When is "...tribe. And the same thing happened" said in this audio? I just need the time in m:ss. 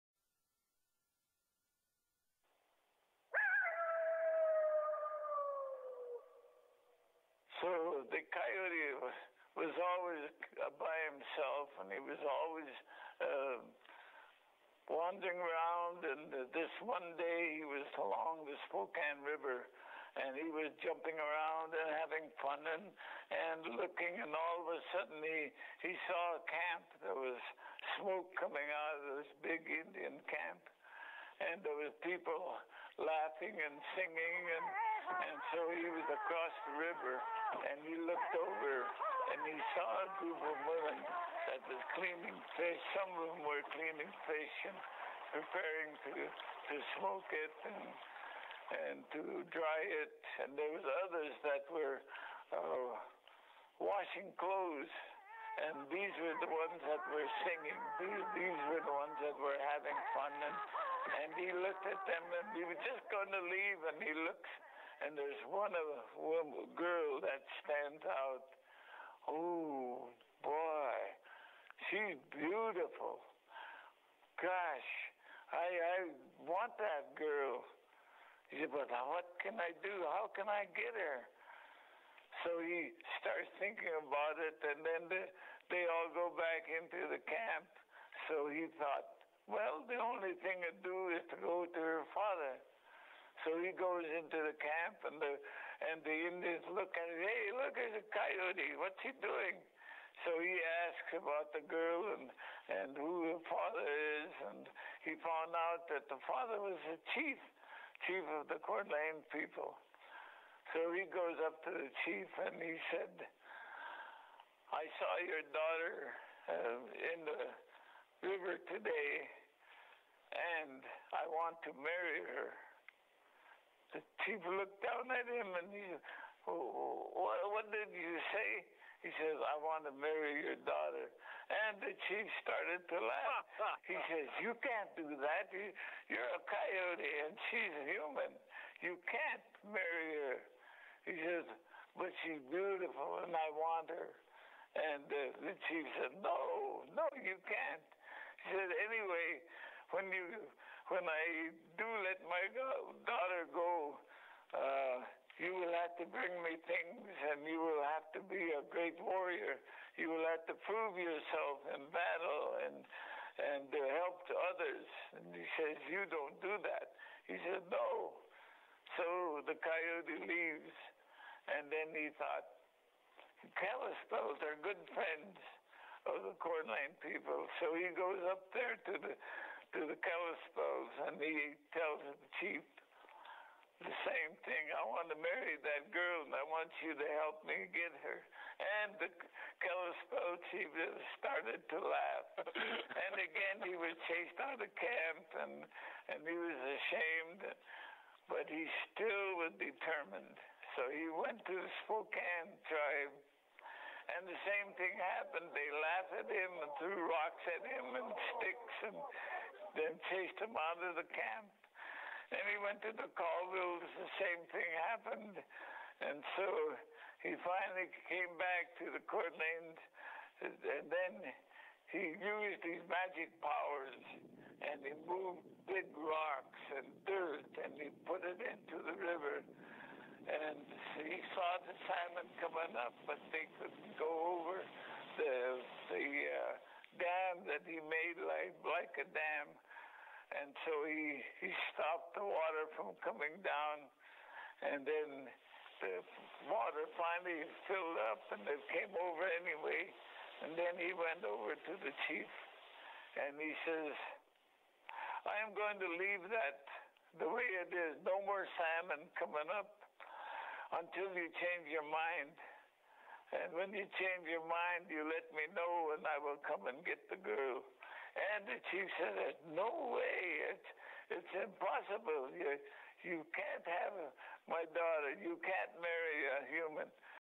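3:22.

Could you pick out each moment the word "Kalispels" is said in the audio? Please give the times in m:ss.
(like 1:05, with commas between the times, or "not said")
2:53, 3:00, 3:09.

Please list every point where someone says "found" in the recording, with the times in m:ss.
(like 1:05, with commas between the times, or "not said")
1:45.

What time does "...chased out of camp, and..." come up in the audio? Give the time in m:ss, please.
3:14.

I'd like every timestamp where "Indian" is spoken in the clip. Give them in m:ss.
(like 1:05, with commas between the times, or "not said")
0:29, 1:36.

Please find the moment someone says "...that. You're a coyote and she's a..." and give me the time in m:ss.
2:15.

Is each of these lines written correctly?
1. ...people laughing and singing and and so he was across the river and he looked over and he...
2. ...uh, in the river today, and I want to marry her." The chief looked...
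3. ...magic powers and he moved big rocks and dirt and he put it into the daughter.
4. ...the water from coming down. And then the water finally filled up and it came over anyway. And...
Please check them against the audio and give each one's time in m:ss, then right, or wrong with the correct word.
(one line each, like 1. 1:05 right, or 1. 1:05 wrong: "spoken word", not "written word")
1. 0:32 right
2. 1:56 right
3. 3:42 wrong: "river", not "daughter"
4. 4:02 right.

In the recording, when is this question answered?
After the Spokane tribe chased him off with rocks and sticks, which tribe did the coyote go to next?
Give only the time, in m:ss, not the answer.
3:33.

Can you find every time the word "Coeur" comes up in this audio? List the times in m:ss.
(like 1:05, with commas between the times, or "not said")
1:48, 2:56, 3:39.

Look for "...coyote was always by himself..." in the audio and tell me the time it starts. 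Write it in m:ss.
0:08.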